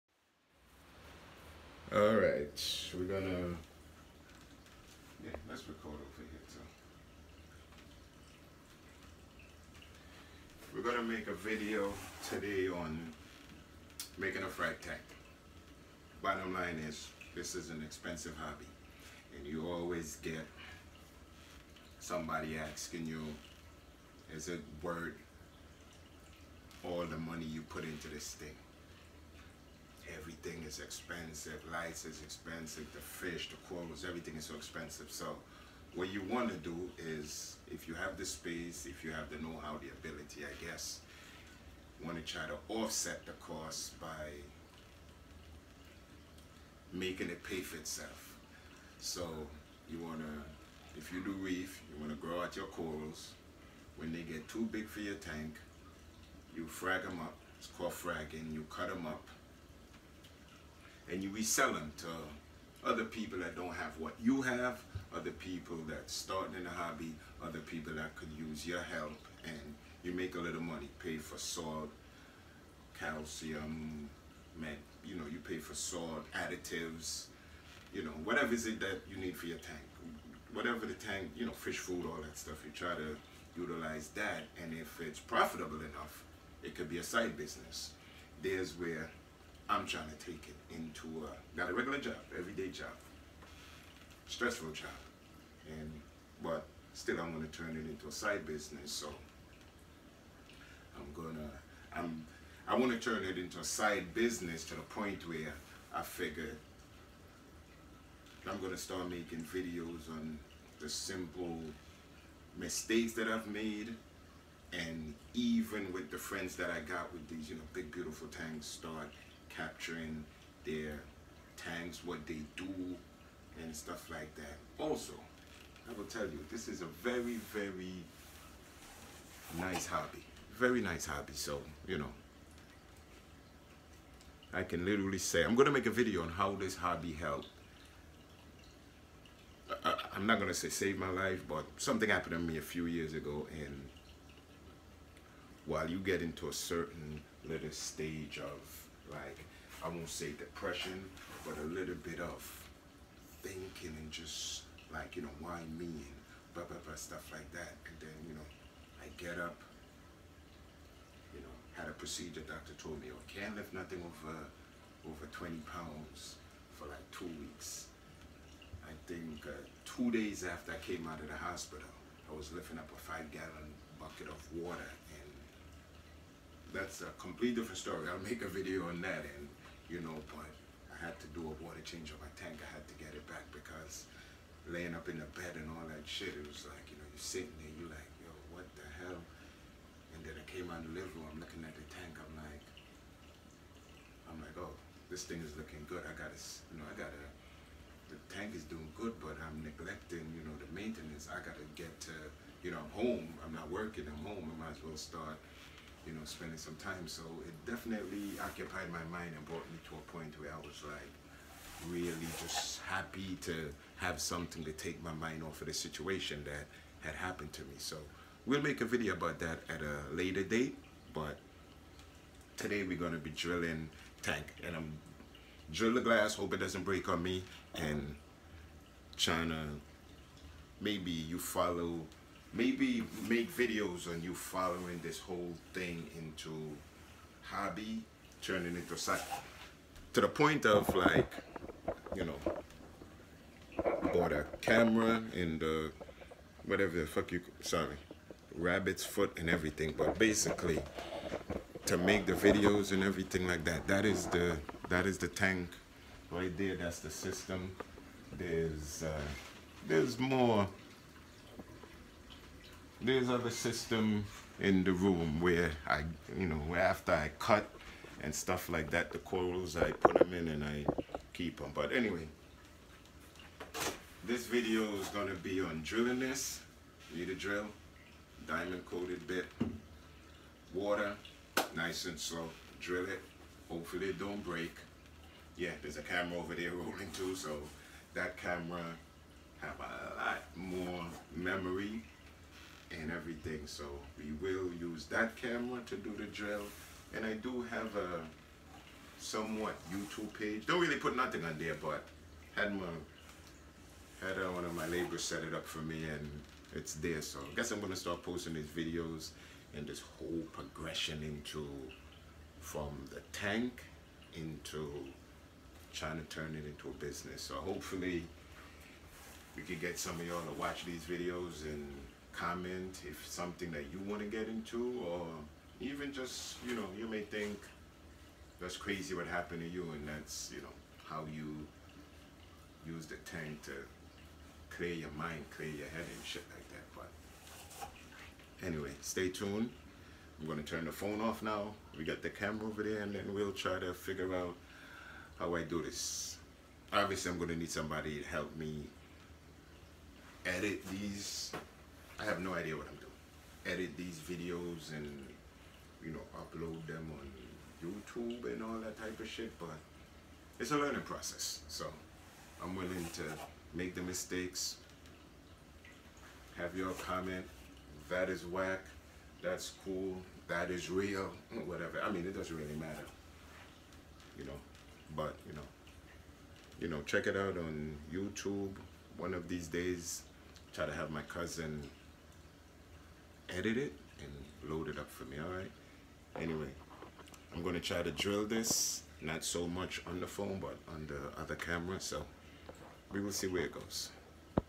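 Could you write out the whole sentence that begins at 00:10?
We're gonna make a video today on making a frag tank.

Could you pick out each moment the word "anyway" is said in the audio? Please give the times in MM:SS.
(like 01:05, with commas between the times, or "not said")
04:31, 05:38, 06:26.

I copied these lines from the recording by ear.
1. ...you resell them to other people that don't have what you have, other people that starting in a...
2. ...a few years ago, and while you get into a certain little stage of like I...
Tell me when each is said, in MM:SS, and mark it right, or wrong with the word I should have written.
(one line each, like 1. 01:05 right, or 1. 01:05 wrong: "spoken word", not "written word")
1. 01:01 right
2. 02:22 right.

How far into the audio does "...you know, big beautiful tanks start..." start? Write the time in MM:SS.
01:57.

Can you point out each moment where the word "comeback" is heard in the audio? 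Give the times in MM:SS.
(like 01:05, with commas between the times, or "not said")
not said.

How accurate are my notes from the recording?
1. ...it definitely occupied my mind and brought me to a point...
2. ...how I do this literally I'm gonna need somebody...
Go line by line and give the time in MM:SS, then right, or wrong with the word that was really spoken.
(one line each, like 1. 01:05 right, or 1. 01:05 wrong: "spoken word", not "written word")
1. 03:27 right
2. 05:45 wrong: "obviously", not "literally".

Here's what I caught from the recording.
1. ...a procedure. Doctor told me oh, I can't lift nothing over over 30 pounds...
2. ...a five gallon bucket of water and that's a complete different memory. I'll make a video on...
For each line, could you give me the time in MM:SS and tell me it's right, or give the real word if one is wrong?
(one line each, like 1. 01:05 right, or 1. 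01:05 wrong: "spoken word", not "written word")
1. 02:41 wrong: "20", not "30"
2. 02:52 wrong: "story", not "memory".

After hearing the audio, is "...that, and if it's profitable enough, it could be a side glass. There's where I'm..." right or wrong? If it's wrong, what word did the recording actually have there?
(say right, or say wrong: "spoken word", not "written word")
wrong: "business", not "glass".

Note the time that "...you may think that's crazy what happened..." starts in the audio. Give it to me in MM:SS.
05:26.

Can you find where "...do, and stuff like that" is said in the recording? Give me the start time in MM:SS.
02:02.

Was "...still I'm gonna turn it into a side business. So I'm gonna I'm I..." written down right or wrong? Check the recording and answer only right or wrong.
right.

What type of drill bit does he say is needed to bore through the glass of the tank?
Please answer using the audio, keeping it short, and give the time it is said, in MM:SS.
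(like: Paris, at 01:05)
Diamond coated bit, at 04:38.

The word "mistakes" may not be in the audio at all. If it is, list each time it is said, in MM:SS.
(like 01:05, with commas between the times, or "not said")
01:52, 06:04.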